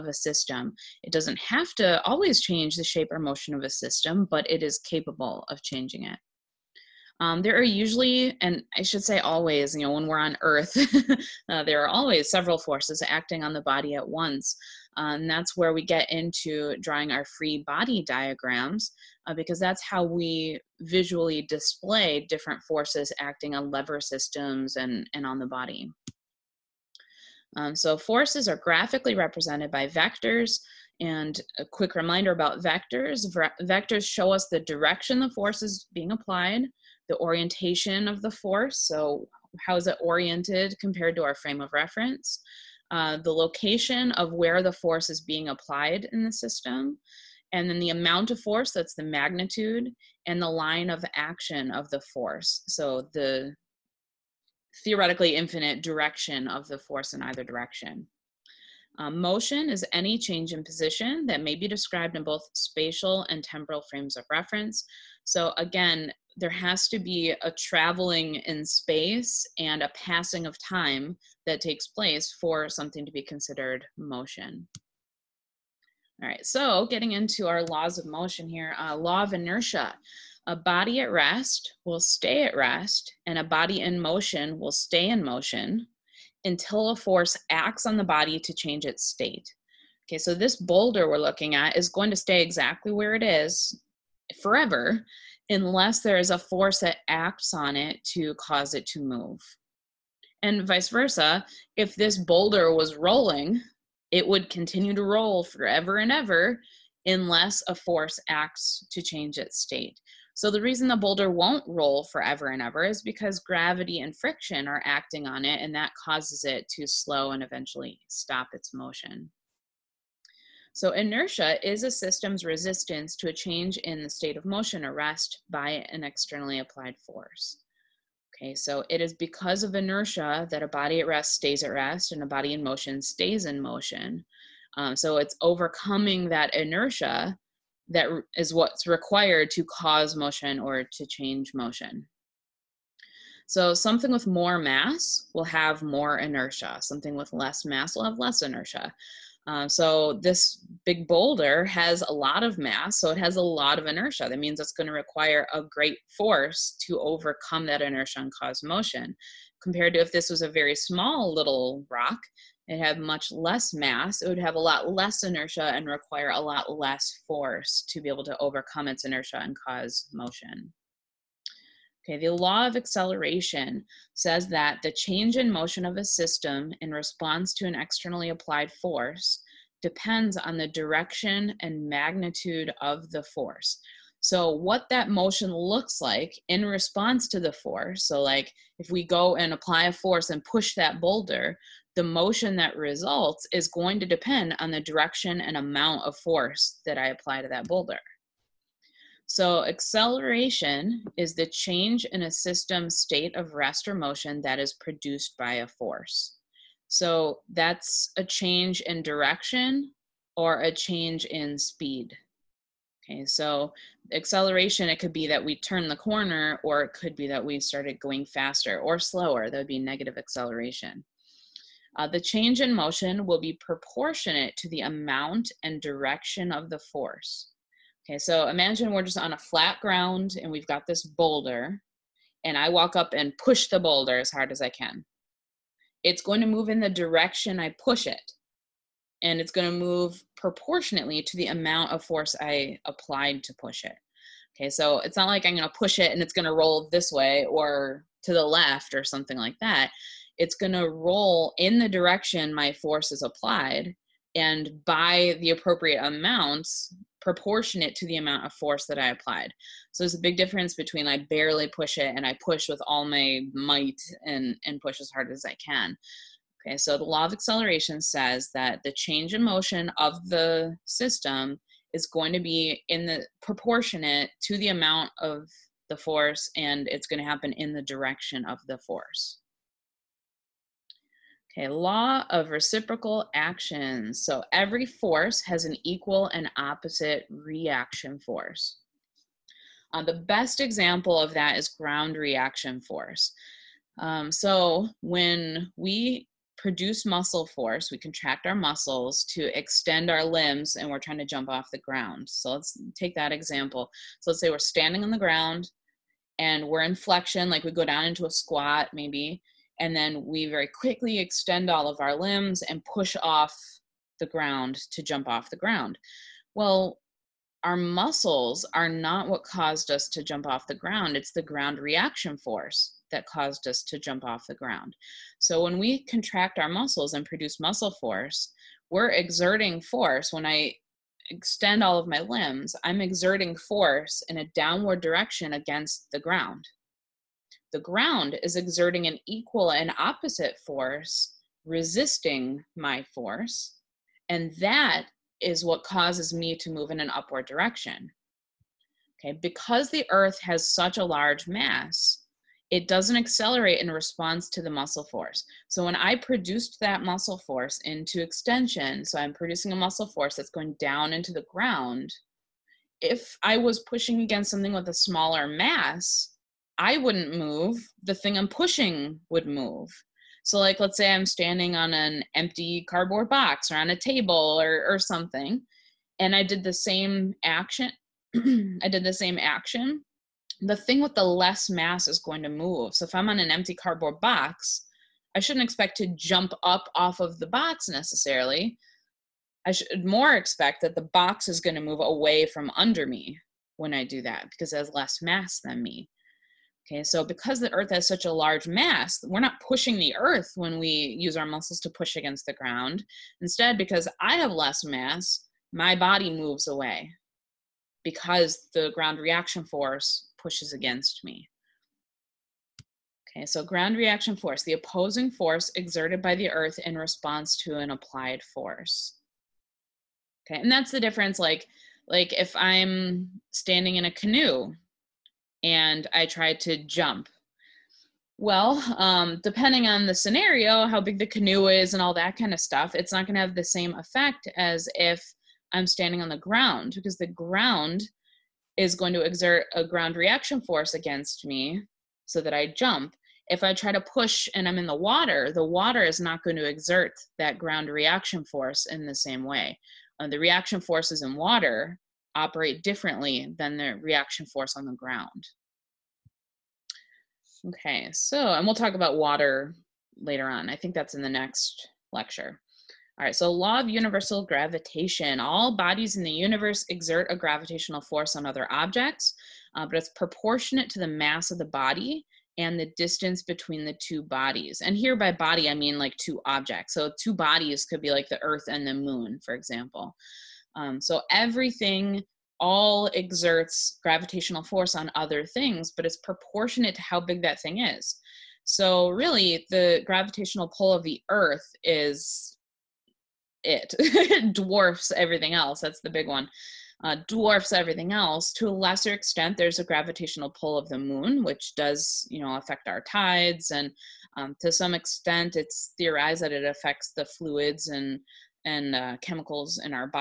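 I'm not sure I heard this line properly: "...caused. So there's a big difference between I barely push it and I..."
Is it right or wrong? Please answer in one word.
wrong.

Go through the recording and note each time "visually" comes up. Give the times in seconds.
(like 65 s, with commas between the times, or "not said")
20 s.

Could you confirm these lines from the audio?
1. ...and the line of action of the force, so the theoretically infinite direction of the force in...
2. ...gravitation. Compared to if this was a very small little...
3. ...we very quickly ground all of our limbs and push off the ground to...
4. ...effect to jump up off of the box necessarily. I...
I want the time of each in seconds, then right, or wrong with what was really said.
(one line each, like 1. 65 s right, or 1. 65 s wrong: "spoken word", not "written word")
1. 50 s right
2. 158 s wrong: "motion", not "gravitation"
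3. 310 s wrong: "extend", not "ground"
4. 385 s wrong: "expect", not "effect".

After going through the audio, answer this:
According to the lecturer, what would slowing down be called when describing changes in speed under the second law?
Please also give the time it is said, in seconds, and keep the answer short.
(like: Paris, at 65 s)
negative acceleration, at 219 s.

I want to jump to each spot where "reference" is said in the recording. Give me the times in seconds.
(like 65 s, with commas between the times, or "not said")
41 s, 64 s.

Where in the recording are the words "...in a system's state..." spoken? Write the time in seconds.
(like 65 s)
202 s.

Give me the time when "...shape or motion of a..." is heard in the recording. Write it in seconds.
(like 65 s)
2 s.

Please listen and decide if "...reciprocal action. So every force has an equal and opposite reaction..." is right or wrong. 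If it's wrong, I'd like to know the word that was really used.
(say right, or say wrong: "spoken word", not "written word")
right.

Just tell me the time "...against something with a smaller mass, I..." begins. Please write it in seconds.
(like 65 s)
364 s.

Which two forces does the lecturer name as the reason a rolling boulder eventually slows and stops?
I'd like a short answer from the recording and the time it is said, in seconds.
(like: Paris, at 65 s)
gravity and friction, at 113 s.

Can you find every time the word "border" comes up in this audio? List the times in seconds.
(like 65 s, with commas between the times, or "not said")
not said.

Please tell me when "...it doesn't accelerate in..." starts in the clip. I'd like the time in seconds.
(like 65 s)
352 s.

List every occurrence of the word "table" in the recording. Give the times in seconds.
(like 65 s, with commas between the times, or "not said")
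373 s.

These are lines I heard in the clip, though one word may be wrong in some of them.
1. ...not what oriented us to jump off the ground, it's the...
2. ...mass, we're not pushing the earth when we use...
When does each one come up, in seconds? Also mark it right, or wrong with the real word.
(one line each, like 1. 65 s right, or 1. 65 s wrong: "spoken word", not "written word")
1. 318 s wrong: "caused", not "oriented"
2. 398 s right.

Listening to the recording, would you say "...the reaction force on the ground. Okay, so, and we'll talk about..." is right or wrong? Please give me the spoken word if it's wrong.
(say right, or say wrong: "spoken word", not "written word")
right.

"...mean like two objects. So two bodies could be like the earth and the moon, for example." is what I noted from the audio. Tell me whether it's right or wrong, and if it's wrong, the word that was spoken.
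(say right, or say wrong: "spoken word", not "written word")
right.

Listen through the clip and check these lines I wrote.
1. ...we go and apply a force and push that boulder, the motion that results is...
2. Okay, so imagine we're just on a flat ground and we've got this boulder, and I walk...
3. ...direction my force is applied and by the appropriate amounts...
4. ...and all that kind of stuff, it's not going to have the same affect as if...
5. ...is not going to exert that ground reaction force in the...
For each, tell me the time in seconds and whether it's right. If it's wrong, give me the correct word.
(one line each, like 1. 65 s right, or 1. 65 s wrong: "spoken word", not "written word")
1. 188 s right
2. 228 s right
3. 251 s right
4. 431 s wrong: "effect", not "affect"
5. 446 s right.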